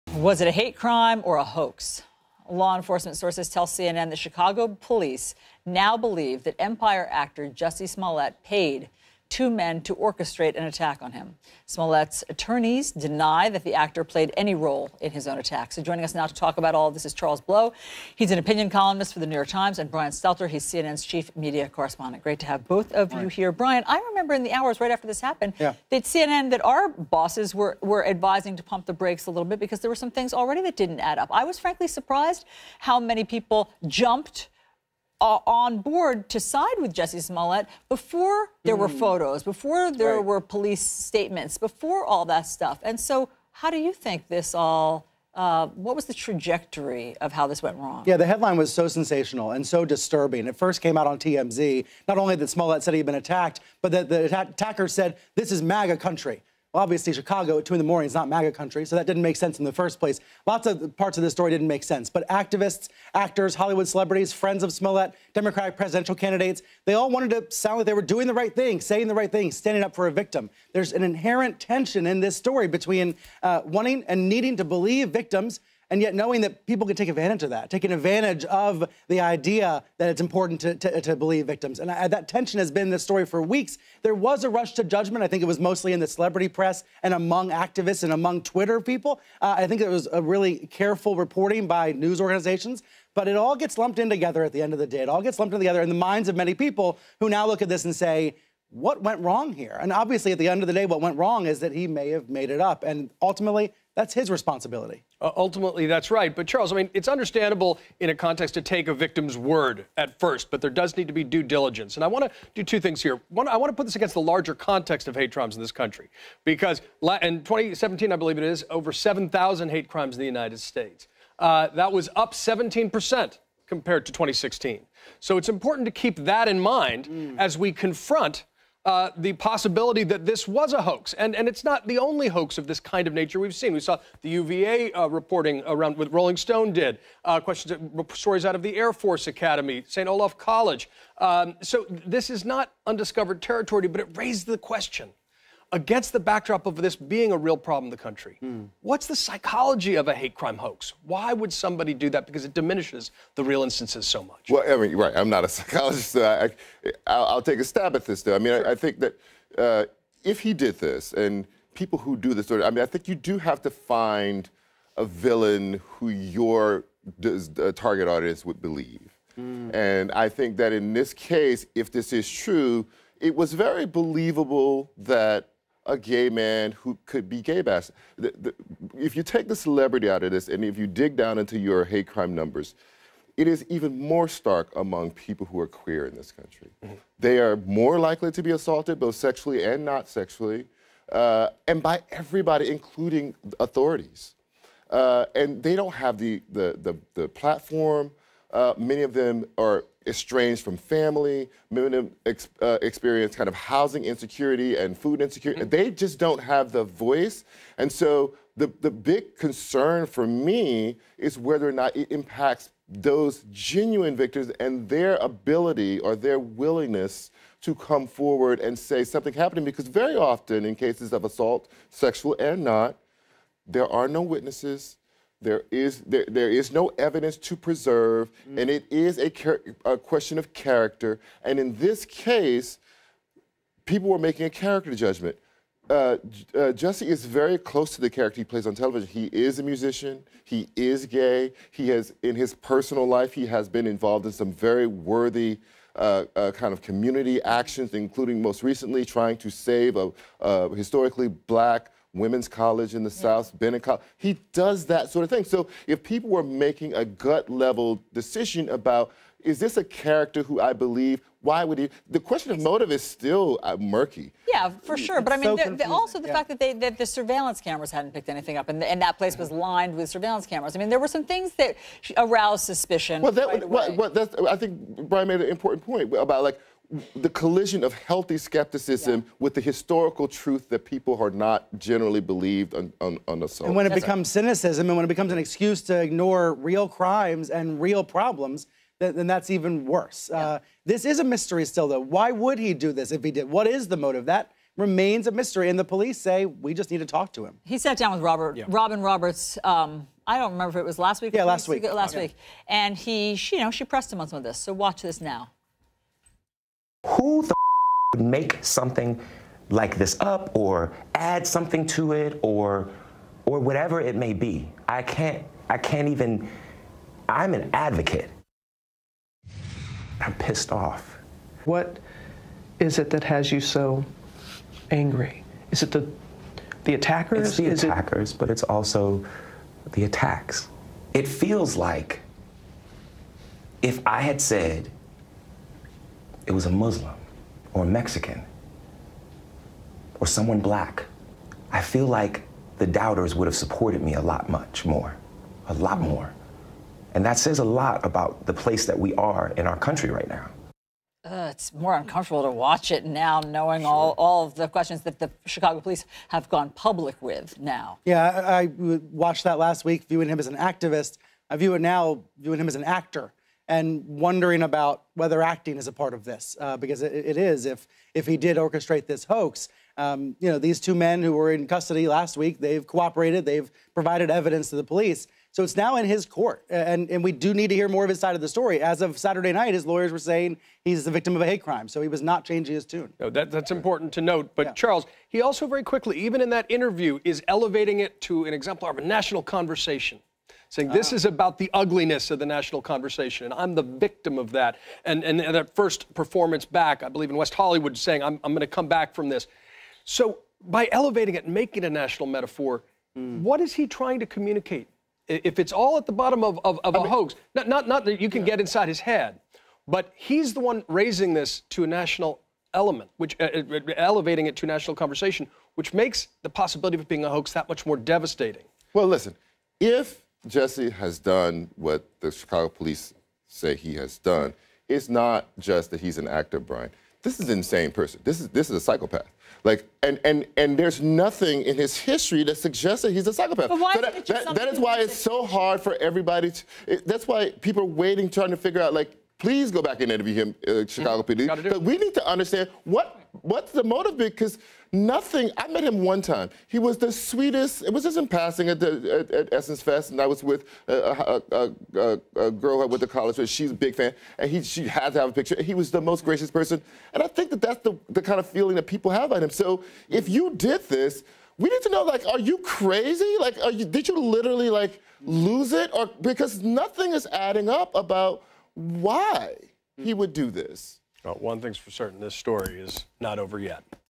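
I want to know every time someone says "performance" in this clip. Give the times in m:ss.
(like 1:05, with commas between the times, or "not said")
6:36.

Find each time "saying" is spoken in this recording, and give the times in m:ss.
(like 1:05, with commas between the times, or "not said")
1:08, 6:20, 6:30, 6:37.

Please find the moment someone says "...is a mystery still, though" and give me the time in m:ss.
4:51.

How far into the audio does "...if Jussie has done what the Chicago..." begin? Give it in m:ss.
6:59.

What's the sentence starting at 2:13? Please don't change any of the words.
We saw the UVA uh, reporting around what Rolling Stone did, uh, questions, uh, stories out of the Air Force Academy, St.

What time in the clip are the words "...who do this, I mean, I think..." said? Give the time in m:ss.
2:41.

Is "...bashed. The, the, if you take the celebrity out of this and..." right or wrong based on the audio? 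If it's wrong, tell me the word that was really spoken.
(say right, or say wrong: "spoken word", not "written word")
right.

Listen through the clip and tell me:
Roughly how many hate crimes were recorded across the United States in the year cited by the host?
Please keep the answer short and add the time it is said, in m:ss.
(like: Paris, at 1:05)
over 7,000, at 1:58.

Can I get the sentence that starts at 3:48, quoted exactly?
and it is a, a, question of character.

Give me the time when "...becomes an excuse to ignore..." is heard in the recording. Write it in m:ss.
4:45.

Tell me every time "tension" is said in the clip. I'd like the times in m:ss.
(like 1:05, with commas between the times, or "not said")
1:11, 1:22.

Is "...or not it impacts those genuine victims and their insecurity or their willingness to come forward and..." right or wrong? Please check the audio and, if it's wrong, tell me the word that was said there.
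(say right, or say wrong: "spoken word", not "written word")
wrong: "ability", not "insecurity".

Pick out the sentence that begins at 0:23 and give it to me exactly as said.
Brian, I remember in the hours right after this happened yeah.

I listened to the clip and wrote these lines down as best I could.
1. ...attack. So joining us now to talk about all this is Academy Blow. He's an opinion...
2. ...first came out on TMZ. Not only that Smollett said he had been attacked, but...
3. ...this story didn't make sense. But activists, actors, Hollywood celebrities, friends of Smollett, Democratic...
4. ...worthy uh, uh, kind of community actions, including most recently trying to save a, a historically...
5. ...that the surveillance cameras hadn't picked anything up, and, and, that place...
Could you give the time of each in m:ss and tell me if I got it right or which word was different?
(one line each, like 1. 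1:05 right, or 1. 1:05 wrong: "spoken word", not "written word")
1. 0:15 wrong: "Charles", not "Academy"
2. 0:50 right
3. 1:01 right
4. 4:04 right
5. 4:26 right.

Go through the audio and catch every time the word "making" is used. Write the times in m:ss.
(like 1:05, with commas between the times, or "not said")
3:54, 4:16, 6:41.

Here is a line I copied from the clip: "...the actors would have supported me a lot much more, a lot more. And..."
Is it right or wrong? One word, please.
wrong.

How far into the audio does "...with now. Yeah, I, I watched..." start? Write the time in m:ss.
5:57.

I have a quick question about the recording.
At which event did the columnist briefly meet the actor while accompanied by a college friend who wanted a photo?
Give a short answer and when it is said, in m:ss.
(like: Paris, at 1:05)
Essence Fest, at 7:29.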